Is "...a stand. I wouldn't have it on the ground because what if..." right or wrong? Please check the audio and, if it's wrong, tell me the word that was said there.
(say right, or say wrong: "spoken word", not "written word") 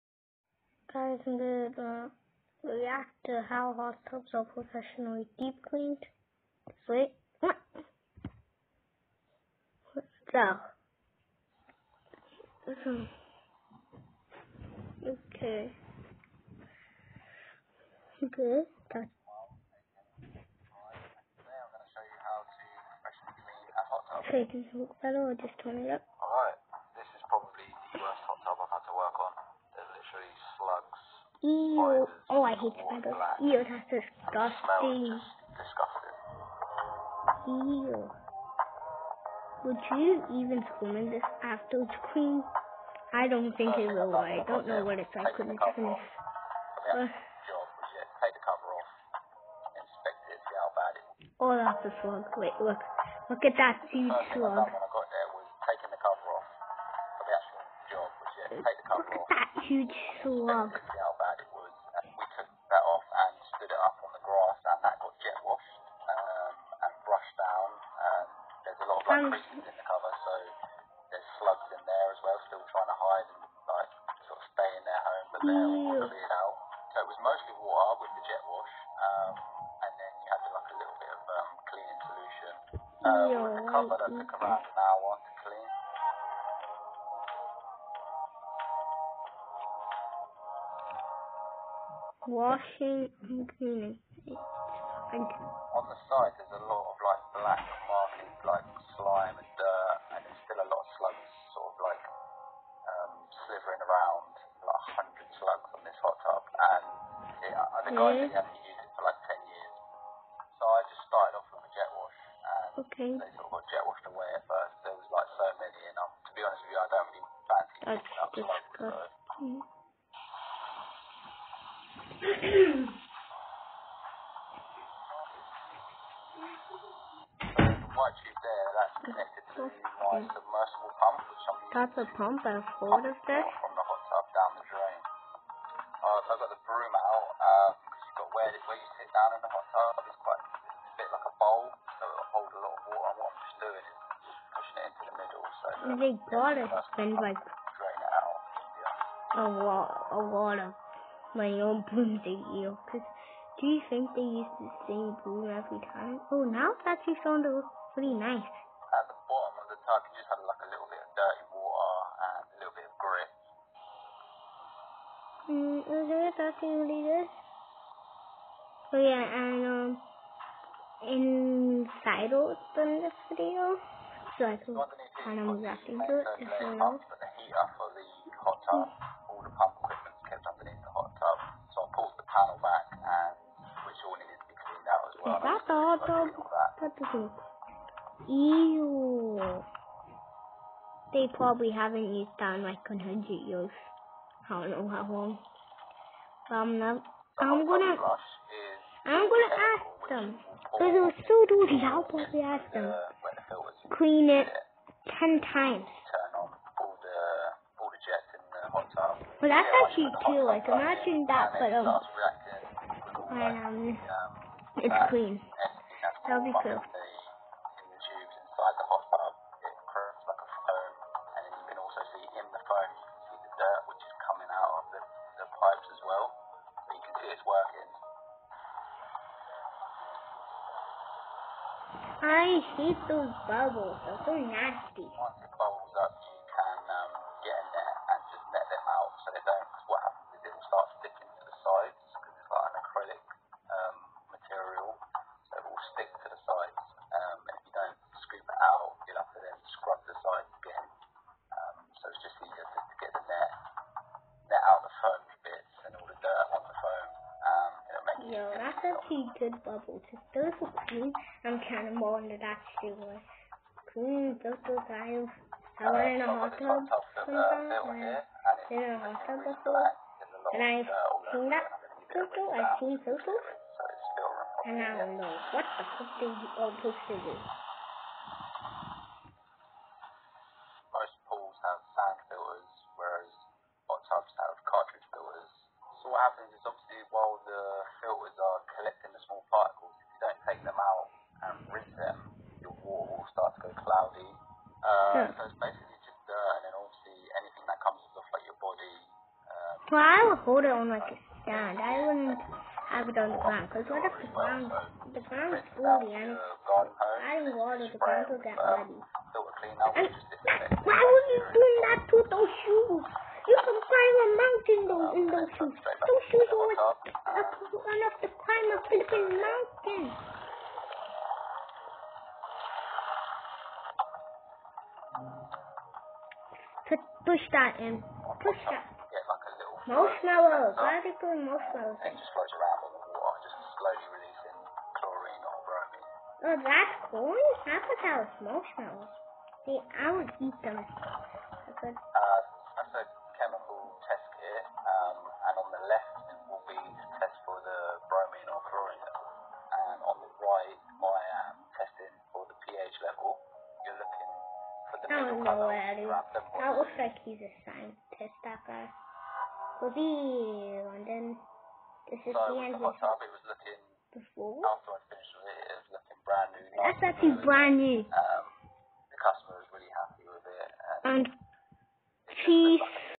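right.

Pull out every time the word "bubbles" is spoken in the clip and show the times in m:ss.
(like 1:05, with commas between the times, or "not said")
3:53, 4:19.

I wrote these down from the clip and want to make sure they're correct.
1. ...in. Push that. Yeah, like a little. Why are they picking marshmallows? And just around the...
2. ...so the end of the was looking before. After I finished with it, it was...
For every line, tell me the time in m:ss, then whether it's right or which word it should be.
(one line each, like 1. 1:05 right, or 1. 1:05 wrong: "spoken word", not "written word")
1. 5:27 wrong: "putting", not "picking"
2. 6:02 right.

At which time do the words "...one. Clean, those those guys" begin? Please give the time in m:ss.
4:22.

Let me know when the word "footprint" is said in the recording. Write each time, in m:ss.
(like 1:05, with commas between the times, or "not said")
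not said.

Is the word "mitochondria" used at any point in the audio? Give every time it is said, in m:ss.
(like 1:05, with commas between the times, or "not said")
not said.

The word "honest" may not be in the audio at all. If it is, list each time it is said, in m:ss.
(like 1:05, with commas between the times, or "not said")
1:56.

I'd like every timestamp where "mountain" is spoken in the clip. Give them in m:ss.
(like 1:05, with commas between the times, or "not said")
5:14, 5:19.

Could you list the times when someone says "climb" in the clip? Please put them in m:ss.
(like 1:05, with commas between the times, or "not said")
5:13, 5:18.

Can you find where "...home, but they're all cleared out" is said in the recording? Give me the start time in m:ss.
1:15.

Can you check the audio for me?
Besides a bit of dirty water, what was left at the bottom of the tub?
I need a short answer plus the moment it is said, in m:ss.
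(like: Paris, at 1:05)
grit, at 2:43.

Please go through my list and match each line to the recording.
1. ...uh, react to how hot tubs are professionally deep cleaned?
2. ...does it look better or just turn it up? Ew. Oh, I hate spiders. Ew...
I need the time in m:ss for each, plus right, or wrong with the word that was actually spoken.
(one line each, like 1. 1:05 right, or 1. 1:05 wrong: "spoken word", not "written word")
1. 0:01 right
2. 0:24 right.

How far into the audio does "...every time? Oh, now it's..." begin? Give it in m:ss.
2:35.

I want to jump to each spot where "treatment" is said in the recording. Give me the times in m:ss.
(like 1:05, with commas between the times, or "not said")
not said.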